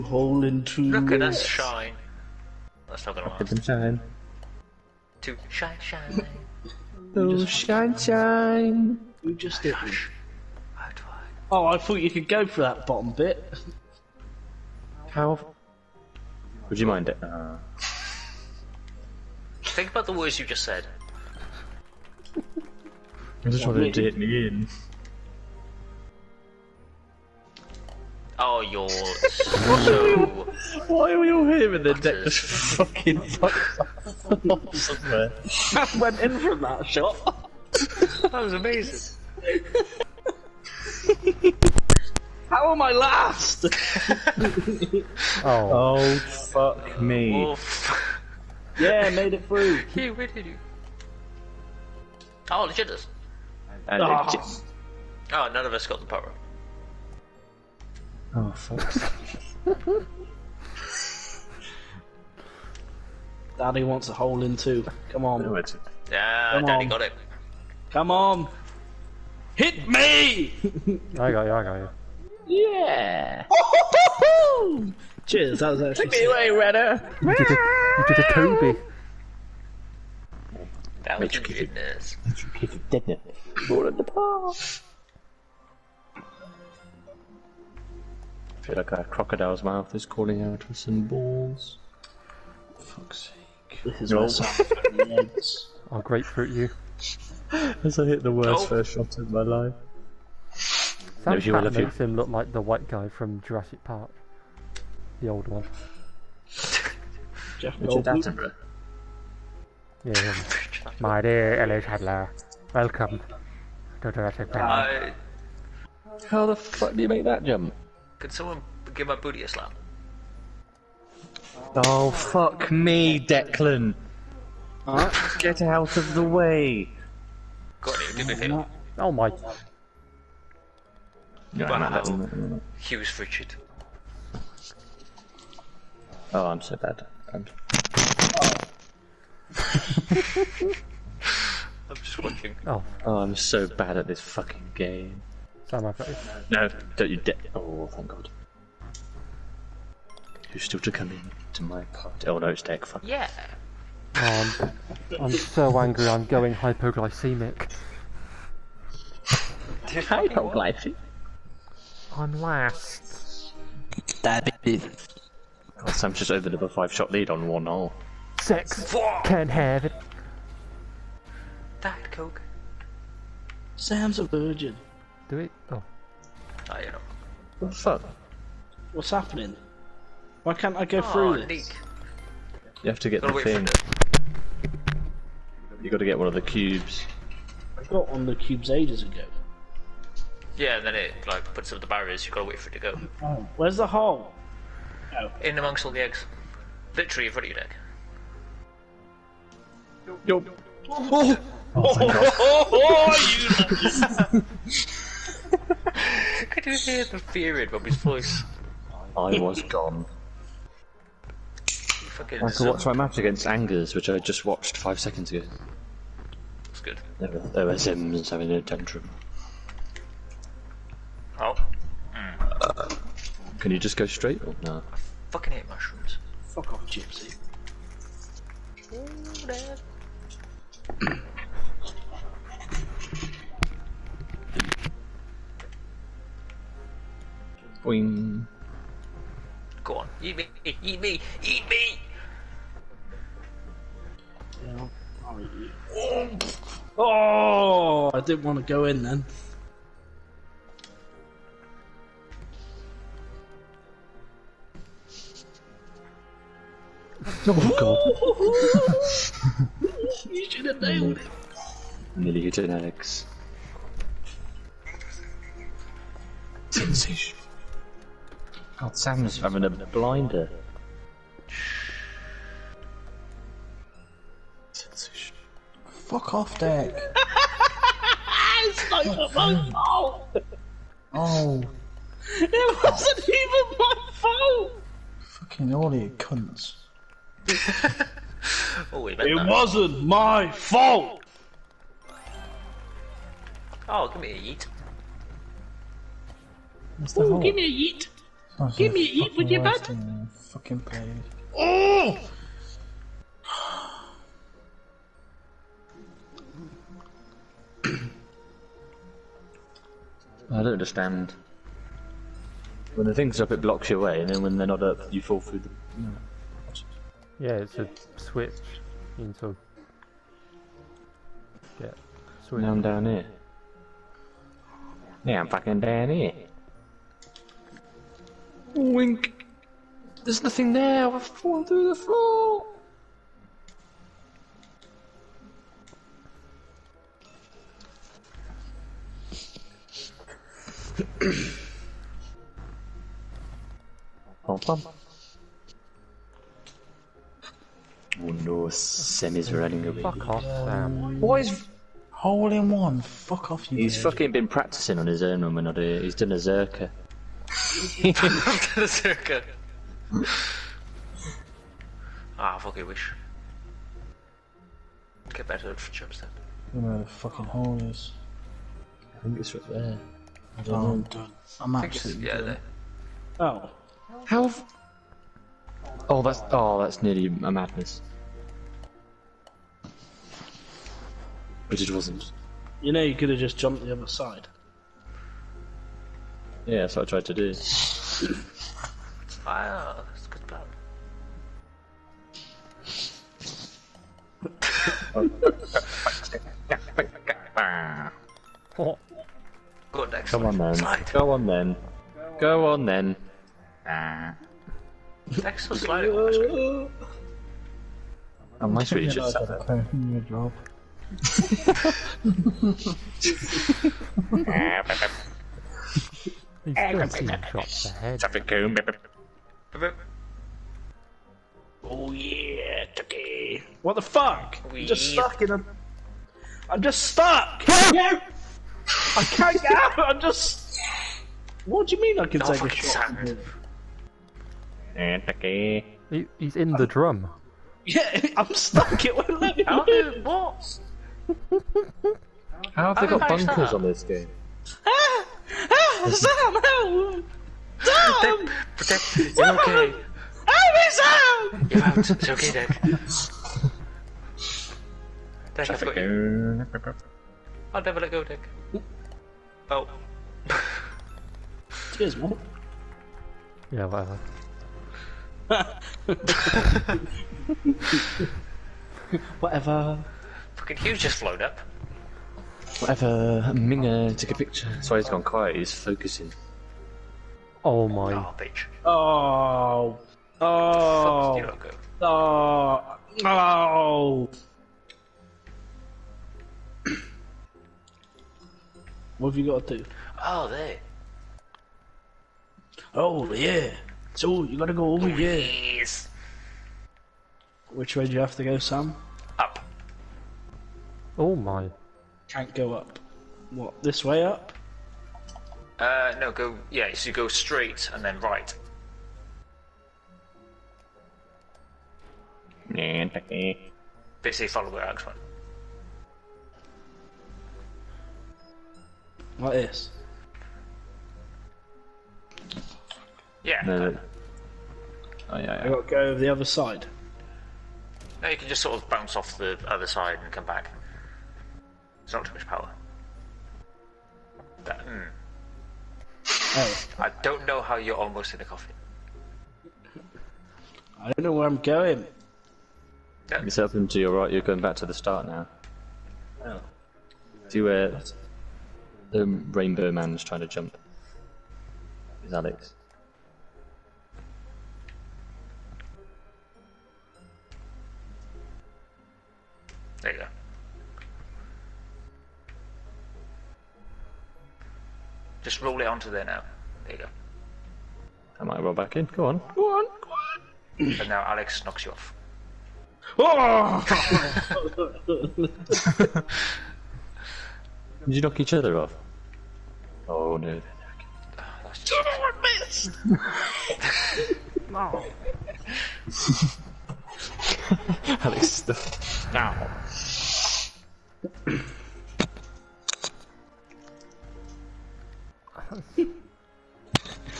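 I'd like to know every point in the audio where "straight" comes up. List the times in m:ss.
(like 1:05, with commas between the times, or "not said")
3:44, 8:27.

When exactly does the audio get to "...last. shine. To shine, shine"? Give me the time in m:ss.
0:03.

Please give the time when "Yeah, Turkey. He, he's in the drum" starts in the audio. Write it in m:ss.
7:14.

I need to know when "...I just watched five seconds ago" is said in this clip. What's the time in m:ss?
3:34.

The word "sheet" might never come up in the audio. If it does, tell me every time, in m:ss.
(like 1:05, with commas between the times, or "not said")
not said.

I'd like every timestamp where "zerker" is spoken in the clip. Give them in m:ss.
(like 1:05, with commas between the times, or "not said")
5:56.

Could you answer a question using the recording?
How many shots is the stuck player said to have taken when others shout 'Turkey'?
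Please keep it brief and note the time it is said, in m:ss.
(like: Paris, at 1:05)
13, at 6:56.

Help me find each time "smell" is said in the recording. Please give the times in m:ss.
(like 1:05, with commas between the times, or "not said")
not said.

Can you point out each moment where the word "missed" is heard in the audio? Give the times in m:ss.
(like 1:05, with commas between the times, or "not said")
9:46.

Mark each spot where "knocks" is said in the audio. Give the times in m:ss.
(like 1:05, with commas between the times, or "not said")
9:31, 9:38.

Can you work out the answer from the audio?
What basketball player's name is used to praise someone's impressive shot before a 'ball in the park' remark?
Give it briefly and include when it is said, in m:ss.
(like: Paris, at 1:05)
Kobe, at 1:18.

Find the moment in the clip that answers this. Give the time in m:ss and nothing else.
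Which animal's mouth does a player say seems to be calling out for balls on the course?
1:29.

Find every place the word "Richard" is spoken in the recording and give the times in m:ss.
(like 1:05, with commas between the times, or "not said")
1:47, 2:13.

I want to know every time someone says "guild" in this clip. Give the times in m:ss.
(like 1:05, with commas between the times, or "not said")
not said.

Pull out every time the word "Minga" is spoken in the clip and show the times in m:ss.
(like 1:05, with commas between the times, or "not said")
7:53.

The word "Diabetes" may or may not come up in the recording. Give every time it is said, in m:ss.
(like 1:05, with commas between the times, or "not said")
2:44.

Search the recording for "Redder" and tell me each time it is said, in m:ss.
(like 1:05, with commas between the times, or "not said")
1:16.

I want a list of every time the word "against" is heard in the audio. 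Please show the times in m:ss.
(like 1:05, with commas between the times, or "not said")
3:33.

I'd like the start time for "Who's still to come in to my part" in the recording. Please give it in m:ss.
2:30.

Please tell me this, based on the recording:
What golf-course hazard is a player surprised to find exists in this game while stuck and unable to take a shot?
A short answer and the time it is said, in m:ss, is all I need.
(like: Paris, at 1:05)
Bunkers, at 7:23.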